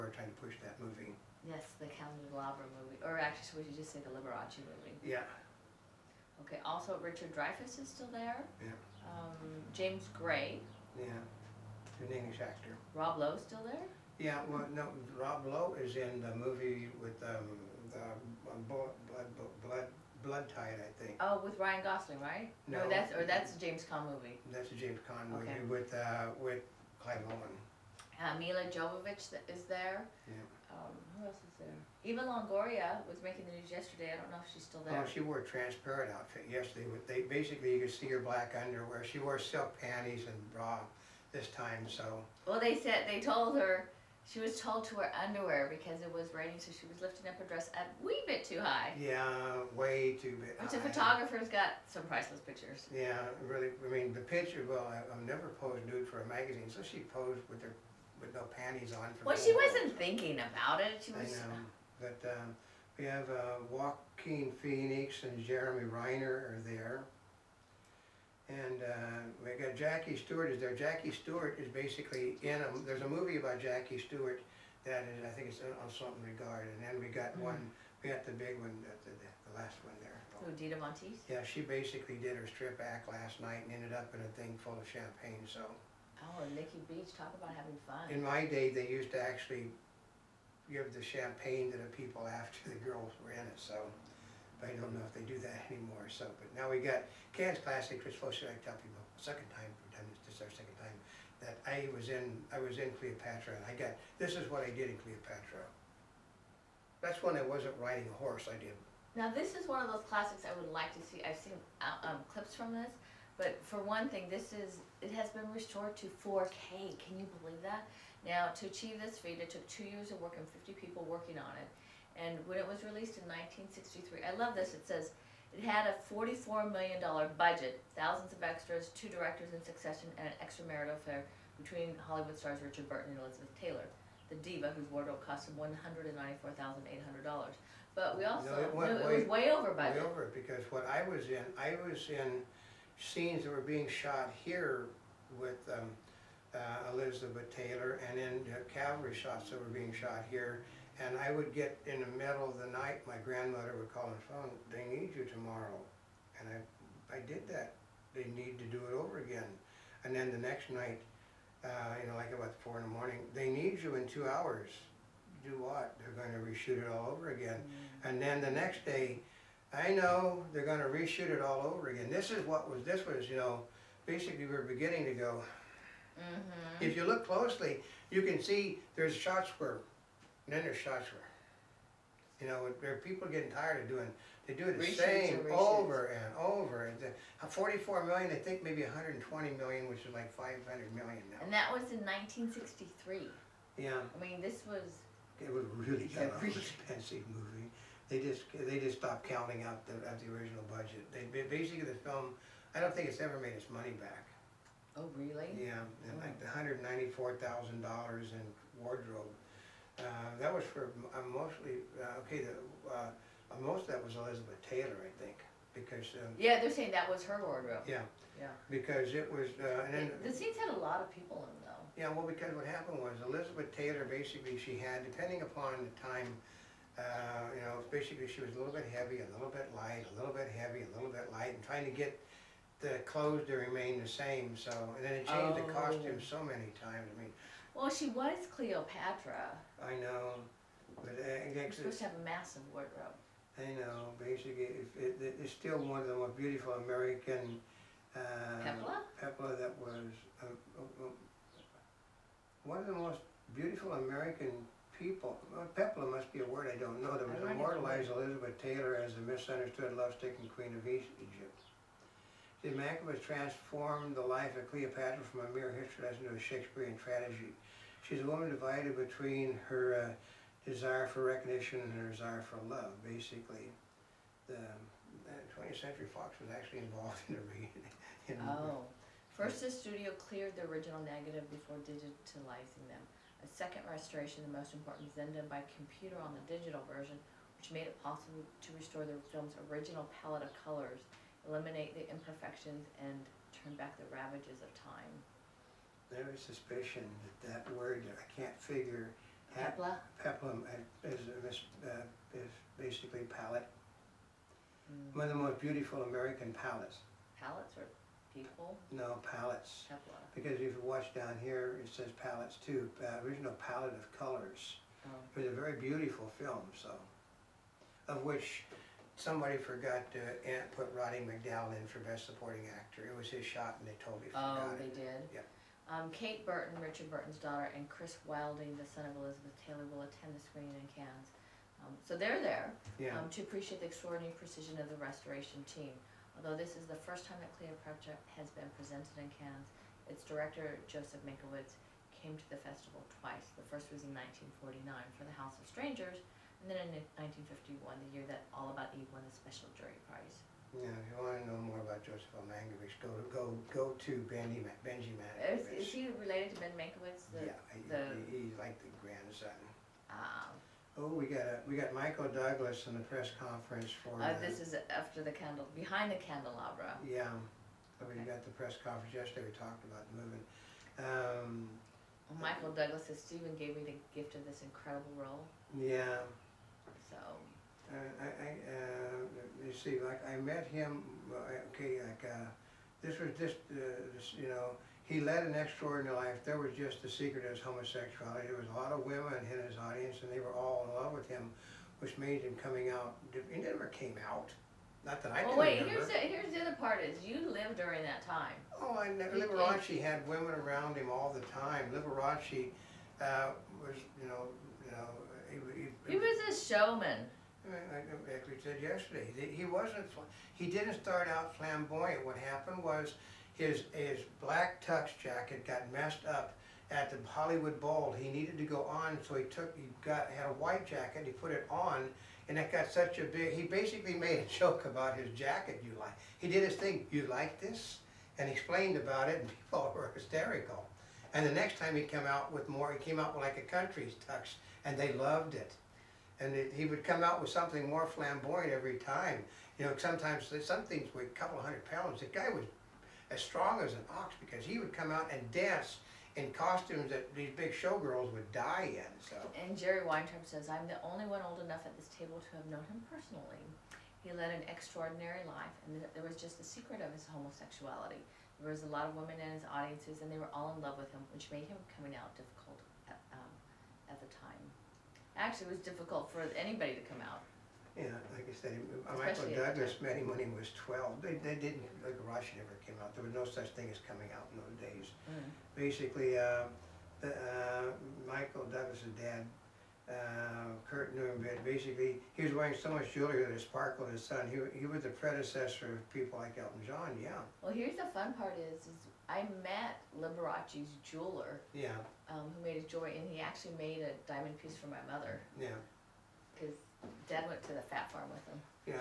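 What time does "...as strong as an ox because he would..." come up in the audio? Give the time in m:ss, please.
7:23.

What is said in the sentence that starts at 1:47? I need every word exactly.
That's when I wasn't riding a horse.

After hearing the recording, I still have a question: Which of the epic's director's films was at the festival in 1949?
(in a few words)
The House of Strangers.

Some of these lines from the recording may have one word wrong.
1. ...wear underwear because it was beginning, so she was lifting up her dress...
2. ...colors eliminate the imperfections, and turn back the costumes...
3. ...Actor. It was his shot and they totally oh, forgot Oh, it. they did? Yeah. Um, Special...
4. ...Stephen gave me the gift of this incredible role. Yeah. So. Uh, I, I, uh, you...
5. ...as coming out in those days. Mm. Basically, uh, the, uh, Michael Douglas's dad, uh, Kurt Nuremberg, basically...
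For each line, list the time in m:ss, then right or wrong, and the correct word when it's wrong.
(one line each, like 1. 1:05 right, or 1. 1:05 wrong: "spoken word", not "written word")
1. 0:44 wrong: "raining", not "beginning"
2. 4:50 wrong: "ravages", not "costumes"
3. 5:22 wrong: "Kate", not "Special"
4. 6:13 right
5. 7:53 right.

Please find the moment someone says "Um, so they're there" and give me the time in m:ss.
5:31.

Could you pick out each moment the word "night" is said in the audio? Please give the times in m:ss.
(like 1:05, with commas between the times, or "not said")
1:23, 2:32, 2:40.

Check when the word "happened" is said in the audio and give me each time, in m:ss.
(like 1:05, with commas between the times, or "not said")
3:42, 6:52.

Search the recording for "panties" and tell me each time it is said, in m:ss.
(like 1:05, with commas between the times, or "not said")
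0:39, 0:58.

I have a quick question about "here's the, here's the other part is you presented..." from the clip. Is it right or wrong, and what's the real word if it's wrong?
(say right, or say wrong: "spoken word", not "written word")
wrong: "lived", not "presented".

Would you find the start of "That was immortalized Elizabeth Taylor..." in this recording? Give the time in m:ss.
4:17.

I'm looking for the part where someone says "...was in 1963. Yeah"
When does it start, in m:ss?
3:11.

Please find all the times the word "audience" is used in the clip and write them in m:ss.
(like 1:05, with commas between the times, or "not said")
6:29, 7:39.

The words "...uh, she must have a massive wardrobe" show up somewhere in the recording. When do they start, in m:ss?
4:01.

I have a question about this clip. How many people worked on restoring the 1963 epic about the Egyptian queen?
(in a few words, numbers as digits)
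50.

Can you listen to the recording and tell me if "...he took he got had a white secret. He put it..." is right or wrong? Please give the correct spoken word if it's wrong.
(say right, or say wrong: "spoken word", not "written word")
wrong: "jacket", not "secret".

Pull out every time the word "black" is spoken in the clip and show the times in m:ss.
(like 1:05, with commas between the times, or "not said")
0:38, 6:54.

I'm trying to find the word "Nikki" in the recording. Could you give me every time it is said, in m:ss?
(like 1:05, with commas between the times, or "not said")
1:26.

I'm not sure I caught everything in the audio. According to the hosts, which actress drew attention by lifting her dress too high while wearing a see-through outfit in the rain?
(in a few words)
Eva Longoria.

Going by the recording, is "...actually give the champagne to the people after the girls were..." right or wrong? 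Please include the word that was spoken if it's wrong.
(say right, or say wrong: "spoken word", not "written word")
right.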